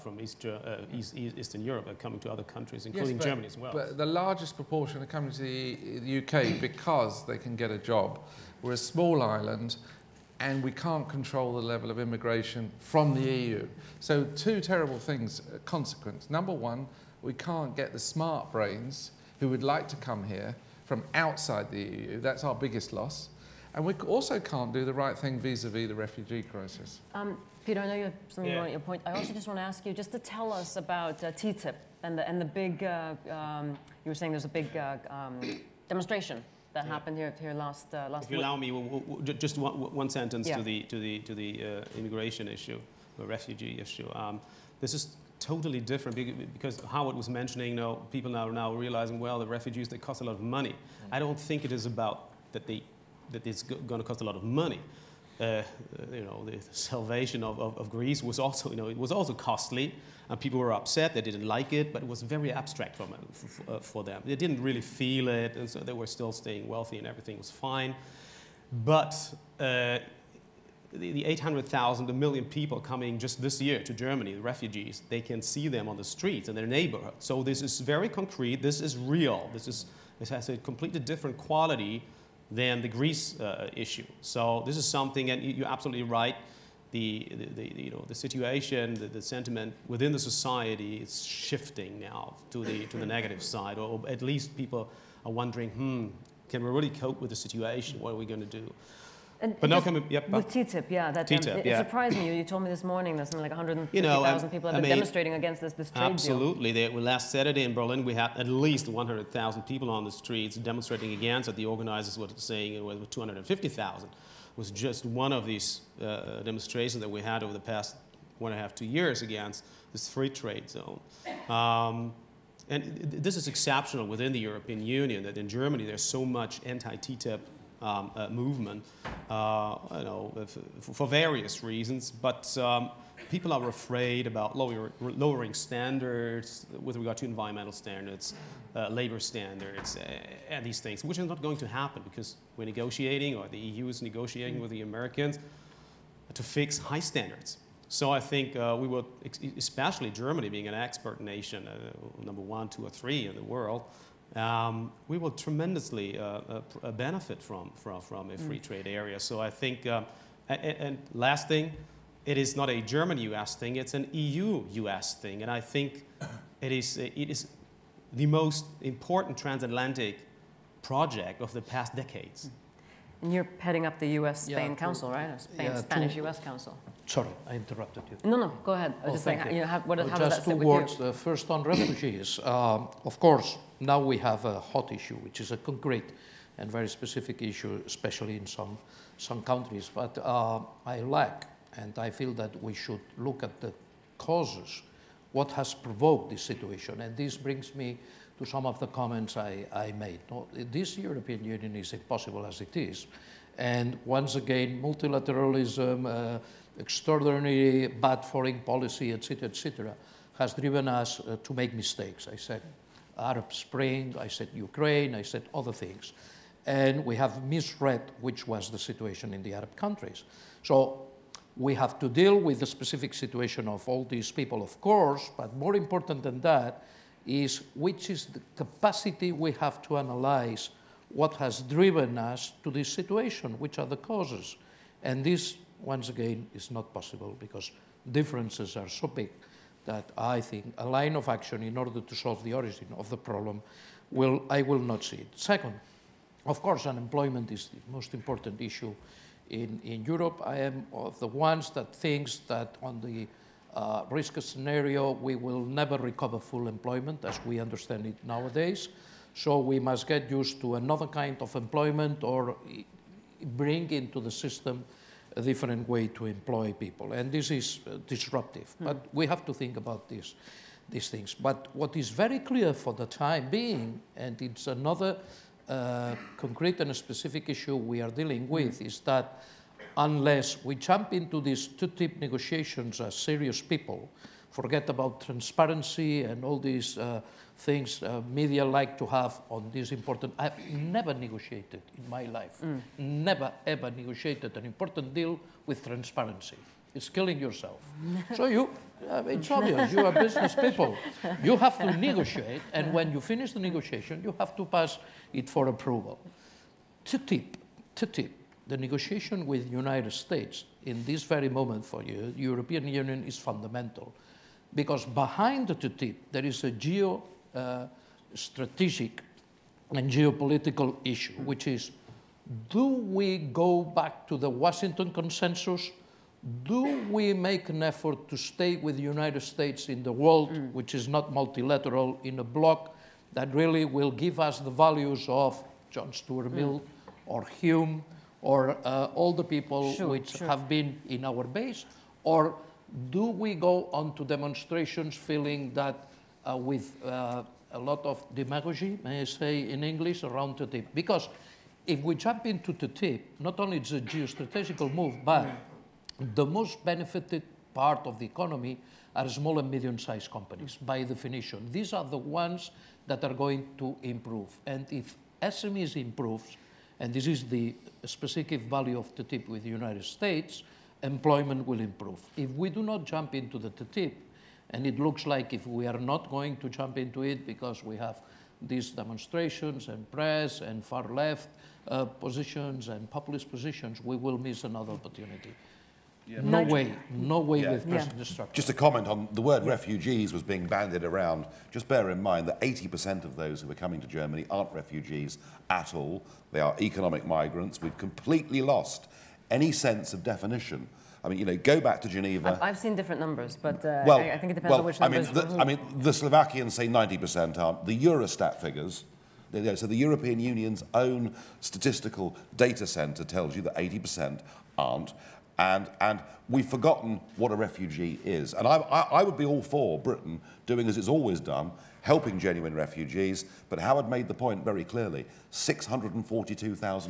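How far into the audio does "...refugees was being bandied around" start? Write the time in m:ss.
6:29.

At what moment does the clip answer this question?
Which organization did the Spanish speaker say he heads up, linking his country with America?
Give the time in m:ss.
2:55.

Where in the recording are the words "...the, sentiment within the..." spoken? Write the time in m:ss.
1:29.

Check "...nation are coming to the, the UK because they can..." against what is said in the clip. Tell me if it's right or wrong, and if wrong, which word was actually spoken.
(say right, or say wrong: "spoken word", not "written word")
wrong: "proportion", not "nation".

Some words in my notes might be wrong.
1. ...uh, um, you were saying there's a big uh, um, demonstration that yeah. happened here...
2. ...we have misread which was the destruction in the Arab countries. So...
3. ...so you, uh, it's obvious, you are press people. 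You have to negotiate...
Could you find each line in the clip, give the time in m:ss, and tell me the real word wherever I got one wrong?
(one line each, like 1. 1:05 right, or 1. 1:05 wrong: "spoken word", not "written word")
1. 0:32 right
2. 3:37 wrong: "situation", not "destruction"
3. 4:58 wrong: "business", not "press".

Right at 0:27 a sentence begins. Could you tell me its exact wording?
Um, Peter, I know you have something yeah.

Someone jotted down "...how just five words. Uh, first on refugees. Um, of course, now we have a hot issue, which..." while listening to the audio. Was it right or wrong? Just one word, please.
wrong.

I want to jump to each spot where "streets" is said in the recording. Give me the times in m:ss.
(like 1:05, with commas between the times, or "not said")
1:16, 1:50.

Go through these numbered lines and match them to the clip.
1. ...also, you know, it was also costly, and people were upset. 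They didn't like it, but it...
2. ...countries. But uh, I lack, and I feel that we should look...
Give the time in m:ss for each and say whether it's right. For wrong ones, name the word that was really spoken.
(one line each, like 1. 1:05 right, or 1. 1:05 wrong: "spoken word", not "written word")
1. 0:58 right
2. 3:09 right.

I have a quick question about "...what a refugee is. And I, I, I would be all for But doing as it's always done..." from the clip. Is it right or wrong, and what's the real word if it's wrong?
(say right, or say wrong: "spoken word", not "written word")
wrong: "Britain", not "But".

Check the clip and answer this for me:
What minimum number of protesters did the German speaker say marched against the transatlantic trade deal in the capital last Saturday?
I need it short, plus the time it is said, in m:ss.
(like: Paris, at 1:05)
100,000, at 1:48.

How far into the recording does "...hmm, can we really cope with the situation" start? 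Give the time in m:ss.
1:35.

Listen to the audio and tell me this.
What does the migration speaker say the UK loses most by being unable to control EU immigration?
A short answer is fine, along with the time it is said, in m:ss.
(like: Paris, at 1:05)
smart brains, at 0:17.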